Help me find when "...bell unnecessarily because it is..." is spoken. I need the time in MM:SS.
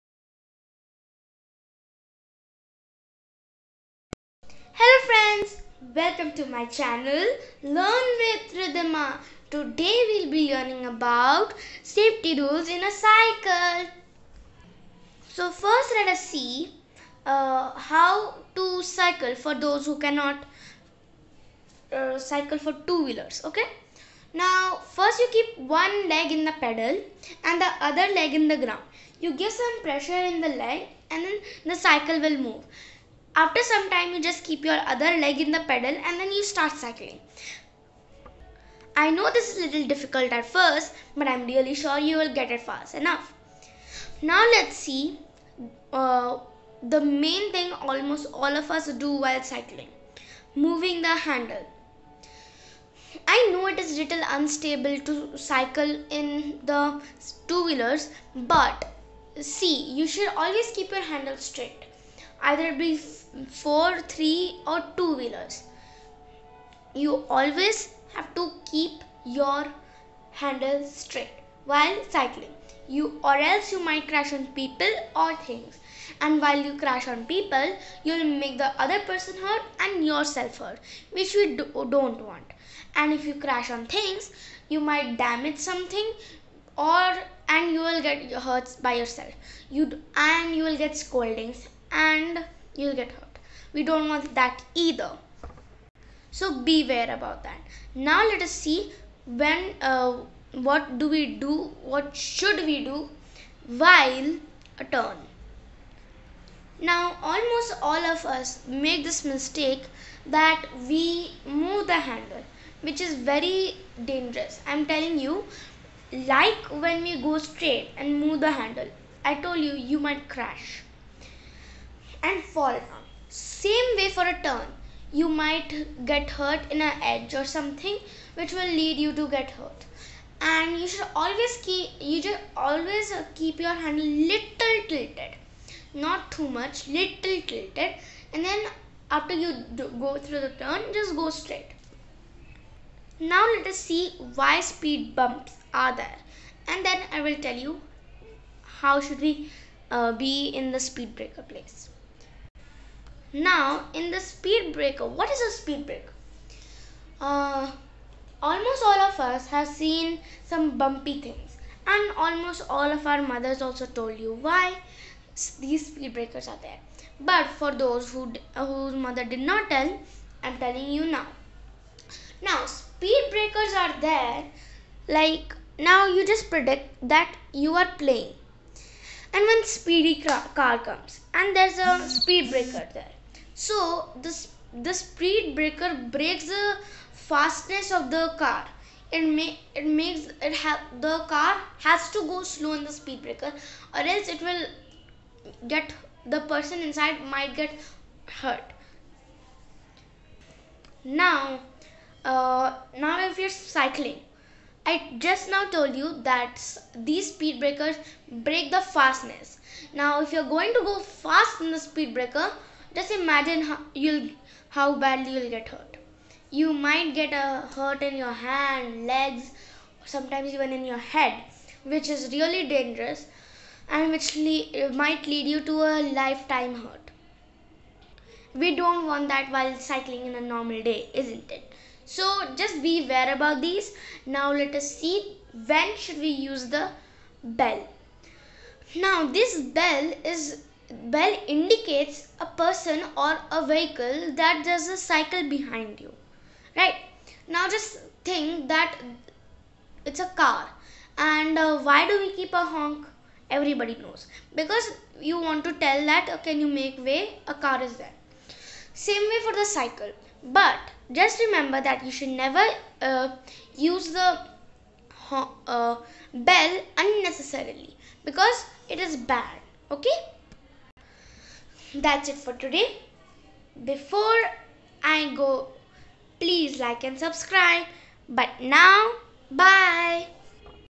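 04:26.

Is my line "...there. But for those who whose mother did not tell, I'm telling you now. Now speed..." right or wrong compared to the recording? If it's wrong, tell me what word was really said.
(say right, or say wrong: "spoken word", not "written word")
right.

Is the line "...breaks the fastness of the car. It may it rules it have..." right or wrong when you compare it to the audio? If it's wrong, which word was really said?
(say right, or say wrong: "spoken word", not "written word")
wrong: "makes", not "rules".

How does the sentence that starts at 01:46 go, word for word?
Now almost all of us make this mistake that we move the handle which is very dangerous.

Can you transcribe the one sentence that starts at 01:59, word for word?
I told you you might crash and fall down.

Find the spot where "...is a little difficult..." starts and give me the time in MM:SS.
00:39.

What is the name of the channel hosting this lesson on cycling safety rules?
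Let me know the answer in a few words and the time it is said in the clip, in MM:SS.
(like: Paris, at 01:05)
Learn with Riddhima, at 00:07.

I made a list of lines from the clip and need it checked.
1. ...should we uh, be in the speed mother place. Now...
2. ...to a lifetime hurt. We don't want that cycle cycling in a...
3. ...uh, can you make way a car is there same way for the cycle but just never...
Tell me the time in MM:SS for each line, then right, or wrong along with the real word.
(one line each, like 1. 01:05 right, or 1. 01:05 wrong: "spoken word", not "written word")
1. 02:28 wrong: "breaker", not "mother"
2. 03:45 wrong: "while", not "cycle"
3. 04:16 wrong: "remember", not "never".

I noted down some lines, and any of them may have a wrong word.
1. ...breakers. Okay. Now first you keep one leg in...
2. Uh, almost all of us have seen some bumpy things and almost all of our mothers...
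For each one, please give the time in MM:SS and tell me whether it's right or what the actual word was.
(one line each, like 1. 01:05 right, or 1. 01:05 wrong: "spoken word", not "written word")
1. 00:23 wrong: "wheelers", not "breakers"
2. 02:37 right.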